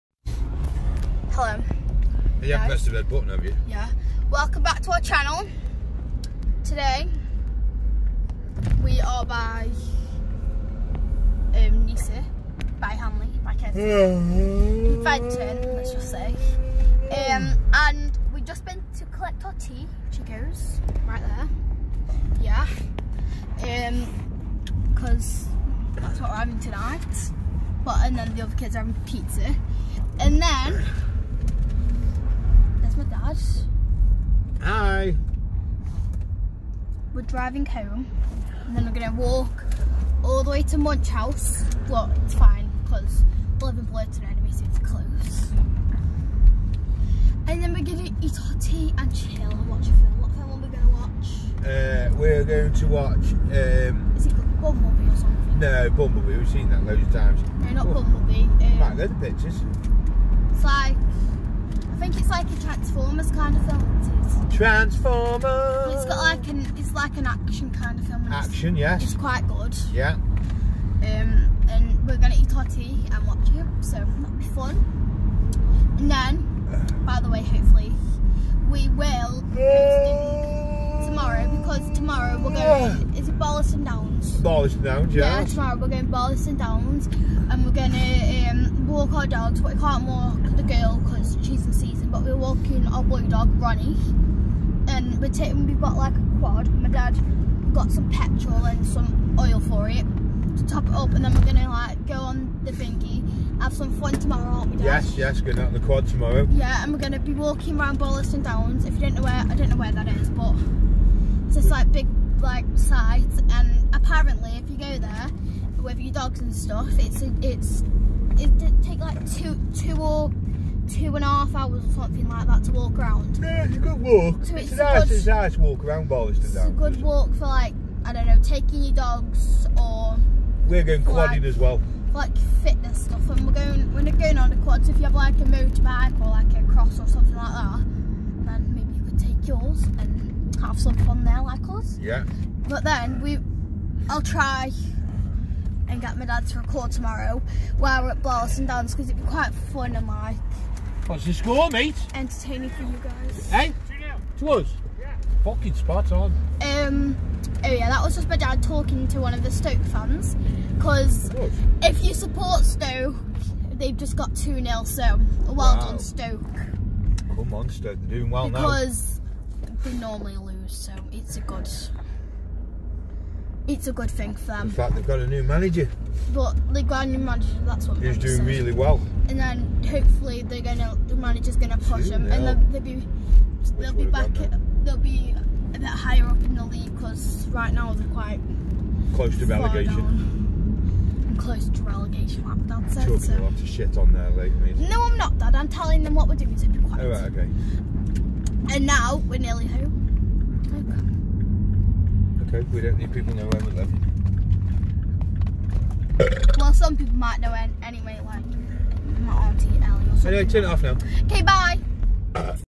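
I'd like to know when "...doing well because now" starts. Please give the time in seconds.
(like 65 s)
168 s.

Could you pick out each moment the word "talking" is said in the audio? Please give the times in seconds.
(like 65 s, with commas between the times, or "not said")
158 s, 193 s.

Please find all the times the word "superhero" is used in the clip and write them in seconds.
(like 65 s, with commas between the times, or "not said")
not said.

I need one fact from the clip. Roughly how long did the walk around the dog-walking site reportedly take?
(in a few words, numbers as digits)
Two and a half hours.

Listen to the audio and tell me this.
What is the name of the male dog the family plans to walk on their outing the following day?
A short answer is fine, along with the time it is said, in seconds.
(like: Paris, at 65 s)
Ronnie, at 93 s.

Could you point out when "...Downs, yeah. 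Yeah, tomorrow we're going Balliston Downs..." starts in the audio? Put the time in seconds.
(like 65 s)
84 s.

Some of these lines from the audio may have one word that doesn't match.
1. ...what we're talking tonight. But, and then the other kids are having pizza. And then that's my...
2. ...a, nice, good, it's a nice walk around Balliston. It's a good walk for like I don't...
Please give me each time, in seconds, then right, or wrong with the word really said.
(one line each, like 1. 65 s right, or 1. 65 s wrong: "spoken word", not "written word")
1. 26 s wrong: "having", not "talking"
2. 124 s right.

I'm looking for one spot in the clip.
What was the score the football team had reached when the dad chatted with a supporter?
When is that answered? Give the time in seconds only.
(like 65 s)
164 s.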